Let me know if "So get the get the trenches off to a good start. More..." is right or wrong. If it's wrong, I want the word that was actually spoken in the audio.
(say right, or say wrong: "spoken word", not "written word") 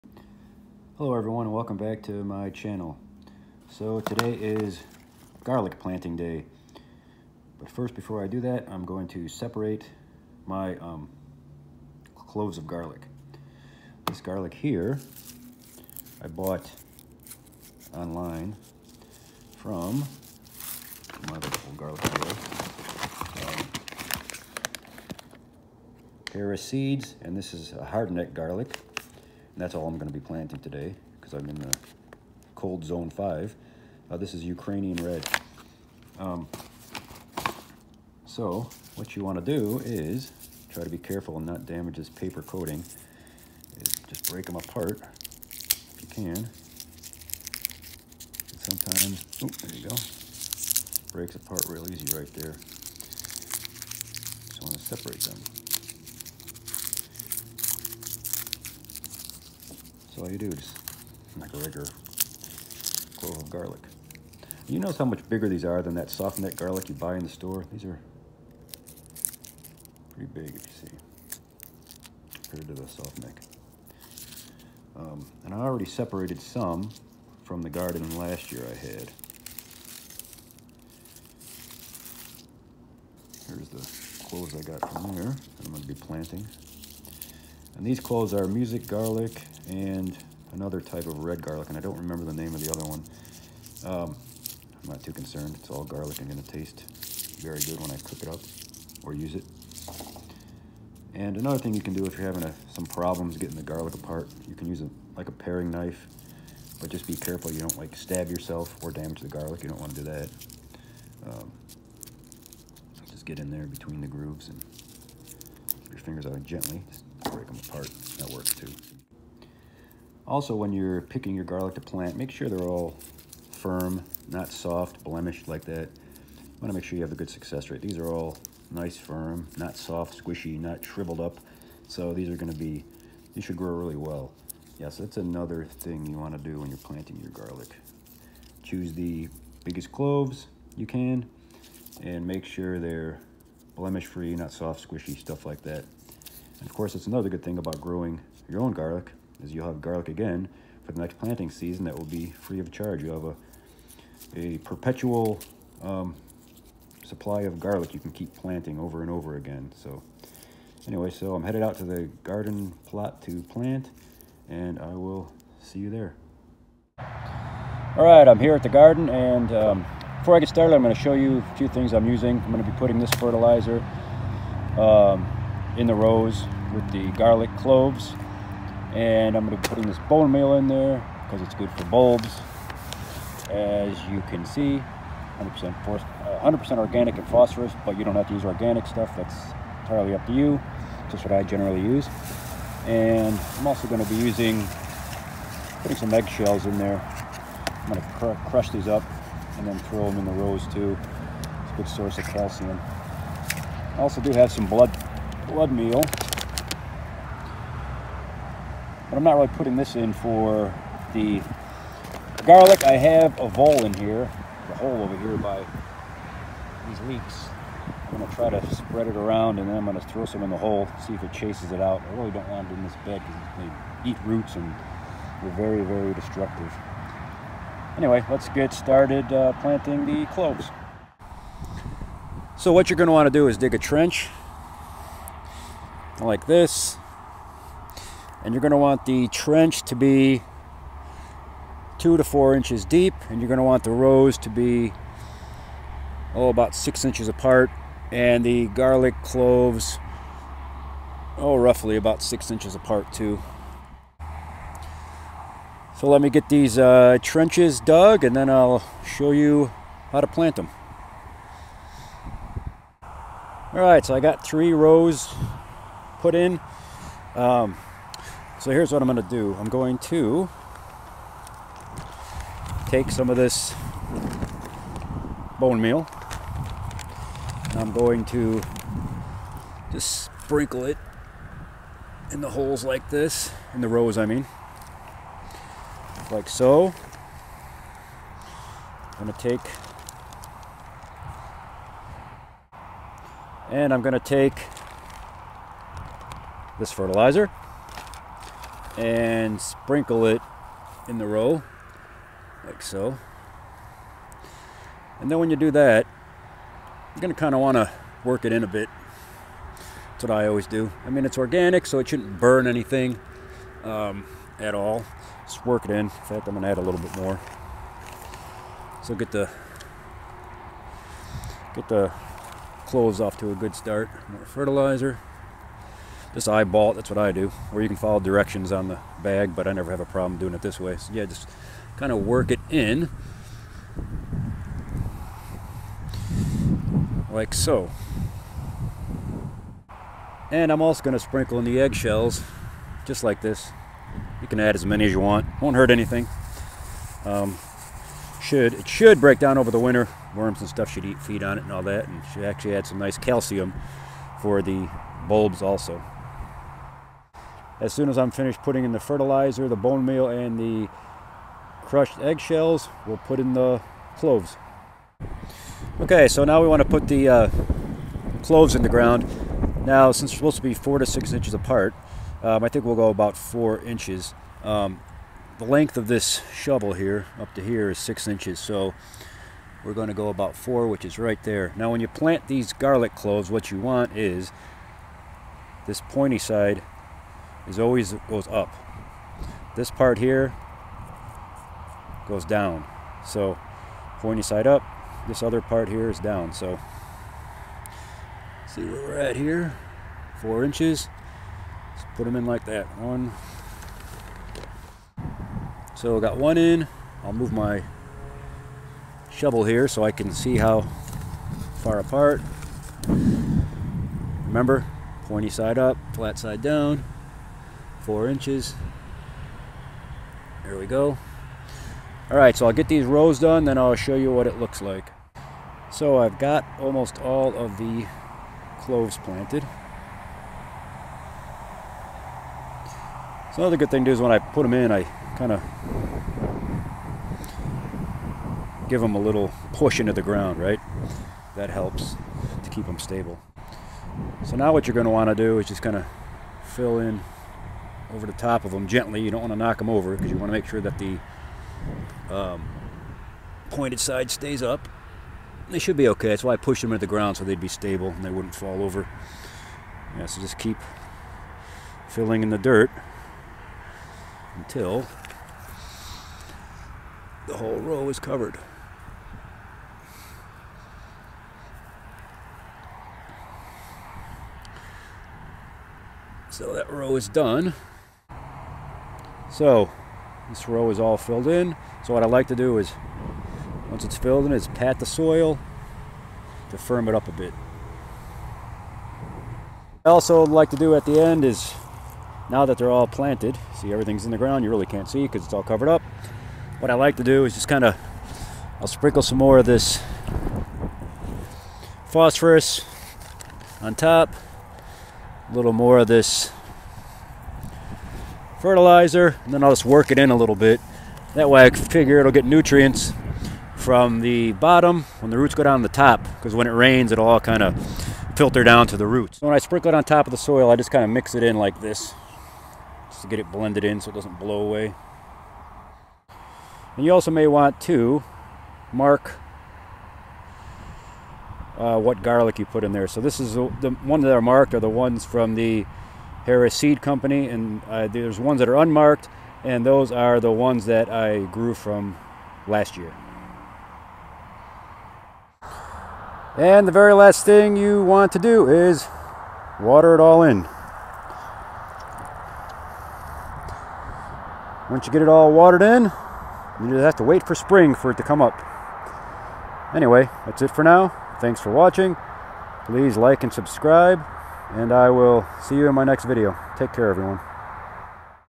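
wrong: "cloves", not "trenches".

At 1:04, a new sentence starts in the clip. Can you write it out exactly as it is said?
You notice how much bigger these are than that soft garlic you buy in the store?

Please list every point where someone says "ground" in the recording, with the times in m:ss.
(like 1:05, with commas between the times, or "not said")
6:08, 7:20, 7:37, 8:14.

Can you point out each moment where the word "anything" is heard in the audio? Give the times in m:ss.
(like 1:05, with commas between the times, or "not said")
5:12, 5:45.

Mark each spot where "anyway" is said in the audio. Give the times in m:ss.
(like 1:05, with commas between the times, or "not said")
2:40, 3:47, 9:19.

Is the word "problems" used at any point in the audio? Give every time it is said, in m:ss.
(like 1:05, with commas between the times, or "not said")
1:42, 5:30.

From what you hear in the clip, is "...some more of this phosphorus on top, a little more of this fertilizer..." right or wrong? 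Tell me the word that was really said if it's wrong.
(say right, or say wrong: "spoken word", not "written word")
right.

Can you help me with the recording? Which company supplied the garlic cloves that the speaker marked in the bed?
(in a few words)
Harris Seed Company.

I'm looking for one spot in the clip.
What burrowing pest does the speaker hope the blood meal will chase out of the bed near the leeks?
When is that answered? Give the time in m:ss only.
3:33.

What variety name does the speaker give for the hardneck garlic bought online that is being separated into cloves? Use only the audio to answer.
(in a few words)
Ukrainian red.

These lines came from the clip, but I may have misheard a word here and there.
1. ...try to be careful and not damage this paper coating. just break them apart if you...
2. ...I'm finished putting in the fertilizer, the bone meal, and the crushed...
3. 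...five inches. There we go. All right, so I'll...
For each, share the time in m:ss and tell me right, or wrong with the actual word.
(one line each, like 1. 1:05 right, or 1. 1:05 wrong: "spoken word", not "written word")
1. 0:40 right
2. 5:58 right
3. 6:58 wrong: "four", not "five".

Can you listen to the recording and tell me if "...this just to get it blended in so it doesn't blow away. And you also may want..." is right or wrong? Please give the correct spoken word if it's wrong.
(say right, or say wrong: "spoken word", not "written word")
right.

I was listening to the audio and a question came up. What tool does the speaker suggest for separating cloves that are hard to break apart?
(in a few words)
paring knife.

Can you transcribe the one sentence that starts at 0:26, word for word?
Um, seeds, and this is a hardneck garlic.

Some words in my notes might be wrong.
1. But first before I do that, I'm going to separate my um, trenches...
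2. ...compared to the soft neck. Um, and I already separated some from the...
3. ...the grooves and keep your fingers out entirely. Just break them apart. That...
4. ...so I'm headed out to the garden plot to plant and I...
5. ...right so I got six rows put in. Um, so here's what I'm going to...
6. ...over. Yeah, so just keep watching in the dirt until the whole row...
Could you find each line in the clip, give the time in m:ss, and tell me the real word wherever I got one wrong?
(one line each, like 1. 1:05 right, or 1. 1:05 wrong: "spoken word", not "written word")
1. 0:07 wrong: "cloves", not "trenches"
2. 1:12 right
3. 1:54 wrong: "gently", not "entirely"
4. 2:41 right
5. 4:23 wrong: "three", not "six"
6. 7:38 wrong: "filling", not "watching".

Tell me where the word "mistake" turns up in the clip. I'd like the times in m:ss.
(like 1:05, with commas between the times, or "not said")
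not said.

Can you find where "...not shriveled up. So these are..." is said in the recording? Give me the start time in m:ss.
2:10.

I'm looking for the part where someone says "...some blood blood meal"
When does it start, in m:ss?
3:24.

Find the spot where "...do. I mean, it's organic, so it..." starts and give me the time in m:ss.
5:10.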